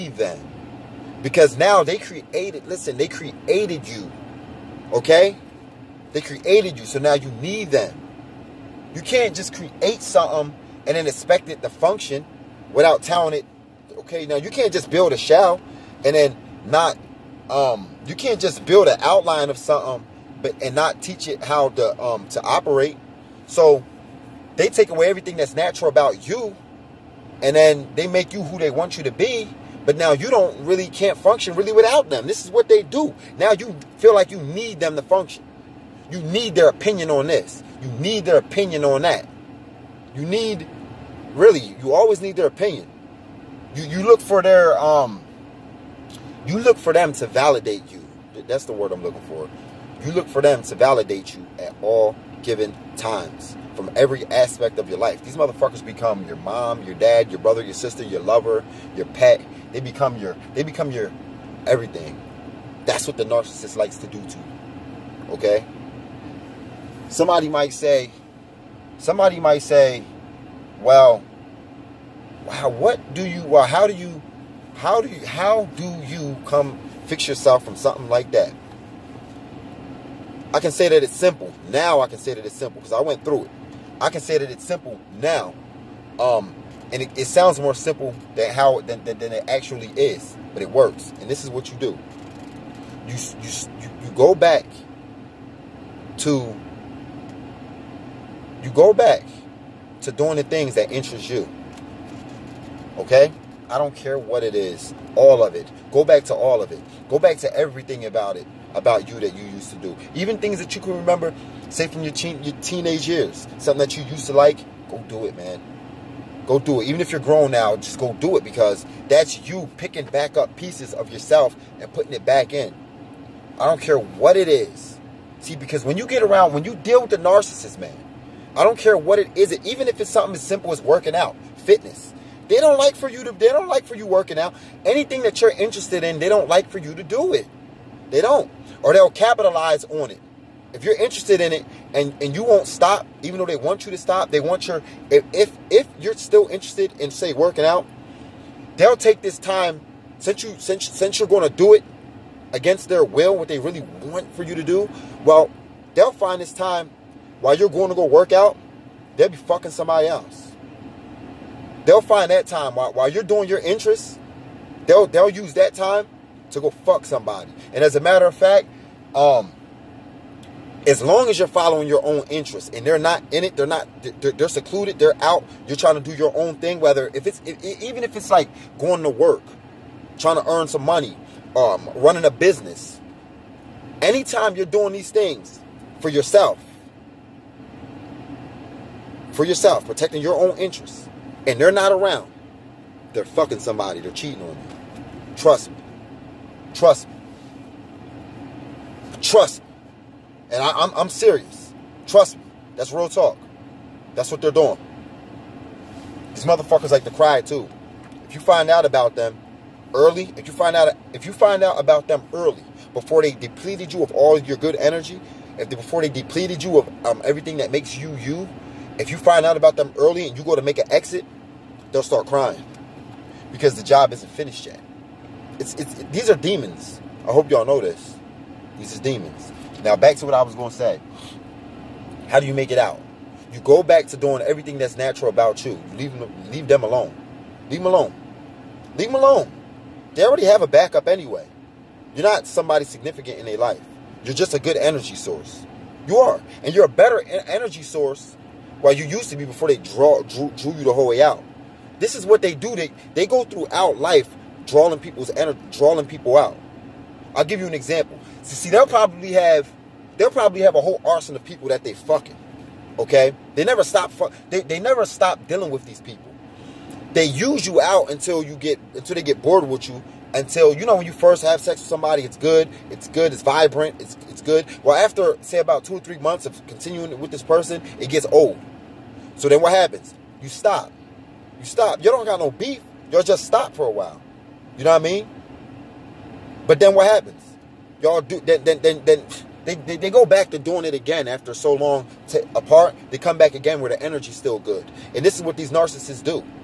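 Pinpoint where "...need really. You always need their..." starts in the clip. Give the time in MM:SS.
00:40.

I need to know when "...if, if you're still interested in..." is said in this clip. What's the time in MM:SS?
02:25.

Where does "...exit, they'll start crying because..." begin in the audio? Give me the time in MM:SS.
03:40.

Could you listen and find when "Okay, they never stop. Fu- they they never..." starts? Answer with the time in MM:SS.
04:23.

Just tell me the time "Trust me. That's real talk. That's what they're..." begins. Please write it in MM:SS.
03:22.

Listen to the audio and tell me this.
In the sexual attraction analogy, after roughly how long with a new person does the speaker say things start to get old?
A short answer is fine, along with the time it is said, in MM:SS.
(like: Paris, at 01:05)
two or three months, at 04:35.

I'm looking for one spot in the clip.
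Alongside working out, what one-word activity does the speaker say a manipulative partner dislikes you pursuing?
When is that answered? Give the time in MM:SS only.
02:11.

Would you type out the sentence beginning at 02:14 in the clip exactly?
Anything that you're interested in, they don't like for you to do it.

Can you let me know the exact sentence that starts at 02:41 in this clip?
They'll find that time while, while you're doing your interests.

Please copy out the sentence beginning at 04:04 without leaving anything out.
You're just a good energy source.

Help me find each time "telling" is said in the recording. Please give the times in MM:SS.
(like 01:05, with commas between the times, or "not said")
00:13.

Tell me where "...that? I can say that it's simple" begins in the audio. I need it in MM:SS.
01:18.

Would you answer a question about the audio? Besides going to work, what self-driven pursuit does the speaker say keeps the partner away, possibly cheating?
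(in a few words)
running a business.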